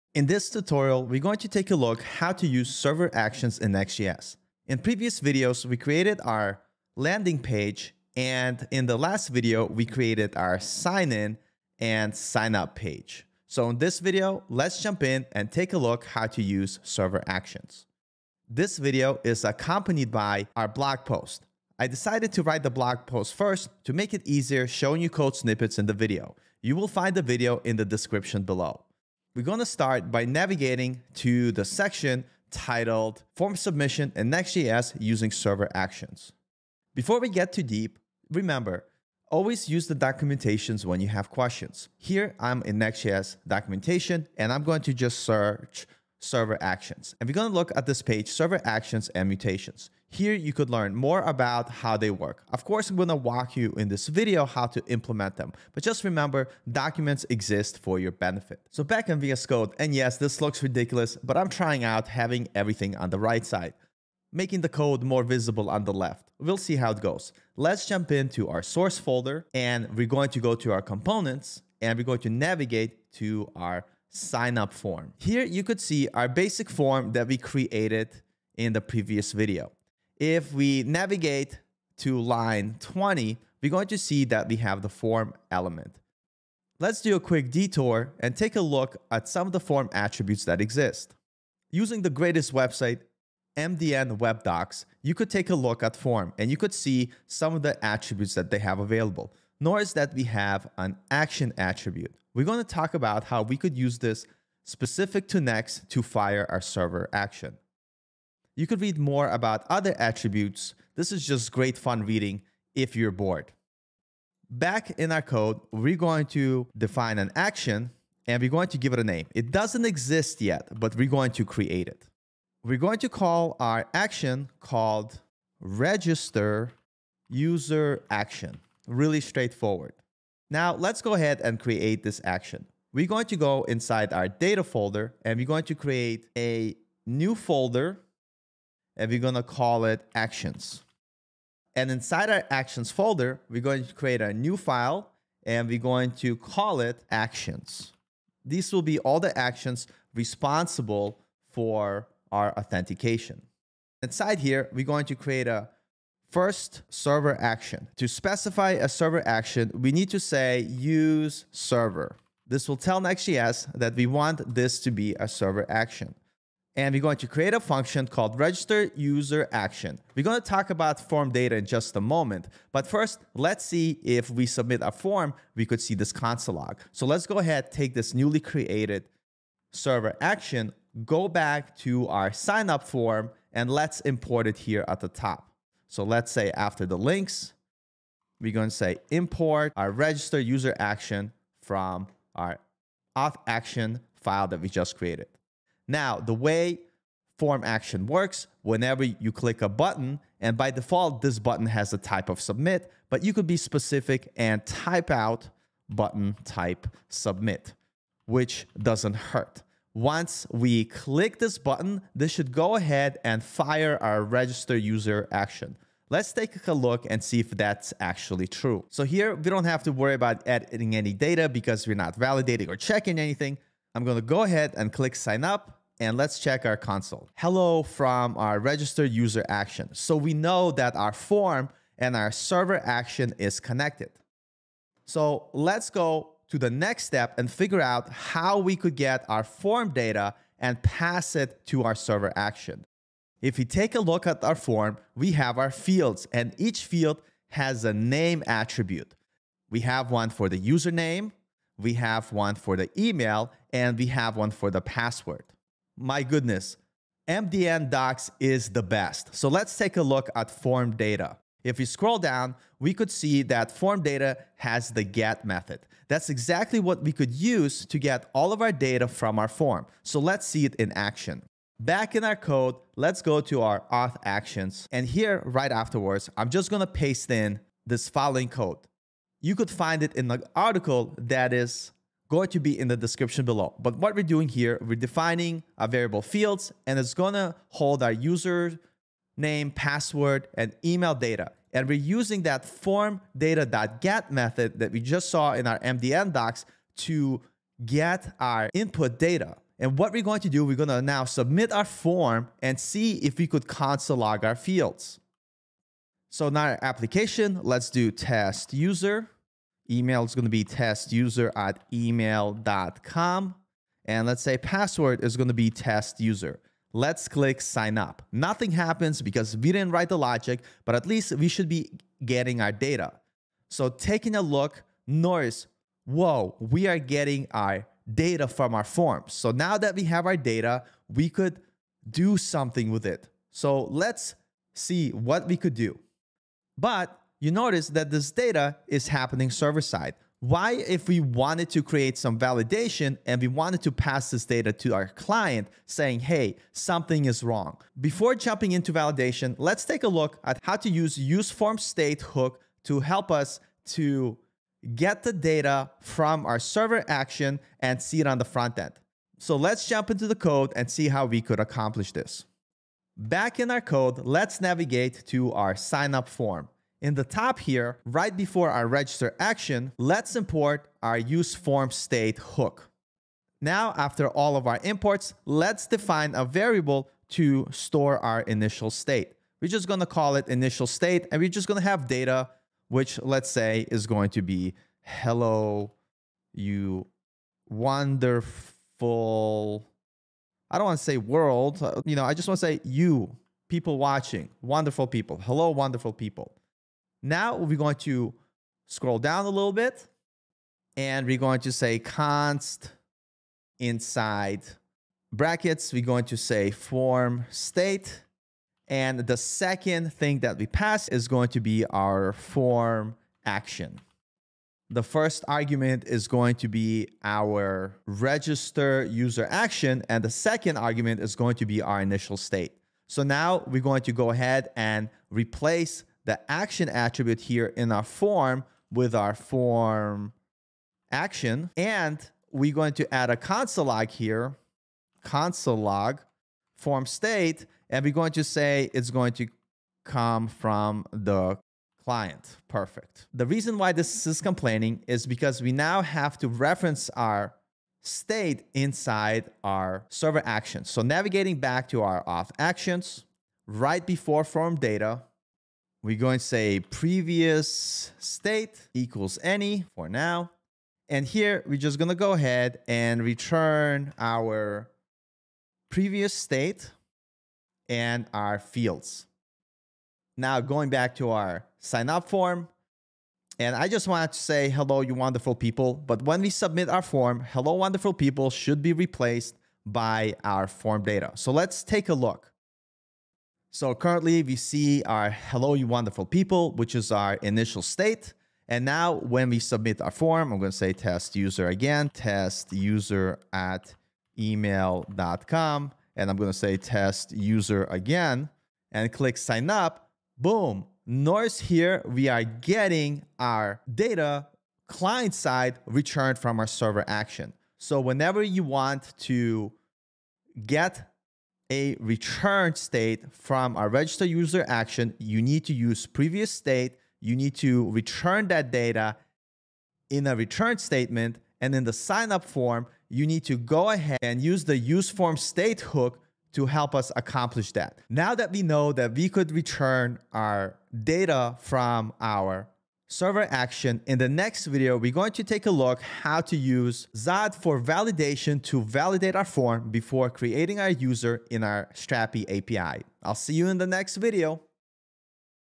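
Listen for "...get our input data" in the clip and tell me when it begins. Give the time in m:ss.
4:57.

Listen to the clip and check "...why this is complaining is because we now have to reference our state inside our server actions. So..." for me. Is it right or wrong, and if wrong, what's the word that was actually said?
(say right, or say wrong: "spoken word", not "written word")
right.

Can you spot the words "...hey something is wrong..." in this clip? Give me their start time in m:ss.
5:46.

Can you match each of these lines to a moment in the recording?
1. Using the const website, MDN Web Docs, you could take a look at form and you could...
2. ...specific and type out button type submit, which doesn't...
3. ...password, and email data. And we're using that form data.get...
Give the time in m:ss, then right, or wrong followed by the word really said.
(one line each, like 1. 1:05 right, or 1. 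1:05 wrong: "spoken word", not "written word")
1. 1:31 wrong: "greatest", not "const"
2. 3:23 right
3. 4:49 right.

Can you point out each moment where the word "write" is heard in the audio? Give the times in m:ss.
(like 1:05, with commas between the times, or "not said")
0:22, 5:19.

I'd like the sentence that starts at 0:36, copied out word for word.
Before we get too deep, remember, always use the documentations when you have questions.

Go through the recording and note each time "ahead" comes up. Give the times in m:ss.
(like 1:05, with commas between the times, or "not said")
2:11, 2:57, 3:32, 3:44, 7:04, 7:42, 8:43.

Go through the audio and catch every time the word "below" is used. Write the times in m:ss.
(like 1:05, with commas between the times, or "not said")
0:28, 4:43.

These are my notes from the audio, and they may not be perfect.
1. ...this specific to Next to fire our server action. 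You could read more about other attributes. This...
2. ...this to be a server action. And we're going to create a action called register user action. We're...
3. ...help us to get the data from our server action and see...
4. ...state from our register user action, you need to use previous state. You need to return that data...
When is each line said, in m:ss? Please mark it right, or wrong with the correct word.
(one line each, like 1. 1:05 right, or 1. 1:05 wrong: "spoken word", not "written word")
1. 1:43 right
2. 2:44 wrong: "function", not "action"
3. 5:53 right
4. 8:32 right.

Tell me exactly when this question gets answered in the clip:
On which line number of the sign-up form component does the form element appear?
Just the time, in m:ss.
1:22.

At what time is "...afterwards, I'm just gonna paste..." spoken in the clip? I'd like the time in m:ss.
4:35.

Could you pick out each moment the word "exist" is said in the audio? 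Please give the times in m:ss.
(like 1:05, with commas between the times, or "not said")
0:57, 1:30, 1:59.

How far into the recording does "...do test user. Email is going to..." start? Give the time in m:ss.
5:07.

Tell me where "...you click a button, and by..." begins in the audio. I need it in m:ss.
3:19.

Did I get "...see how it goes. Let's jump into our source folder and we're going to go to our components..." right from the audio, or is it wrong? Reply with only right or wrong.
right.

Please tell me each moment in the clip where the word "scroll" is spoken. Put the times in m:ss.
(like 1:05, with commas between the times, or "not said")
4:21, 6:38.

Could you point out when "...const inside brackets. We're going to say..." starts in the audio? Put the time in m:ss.
6:41.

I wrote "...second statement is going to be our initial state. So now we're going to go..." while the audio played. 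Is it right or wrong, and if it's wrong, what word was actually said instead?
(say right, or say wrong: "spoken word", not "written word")
wrong: "argument", not "statement".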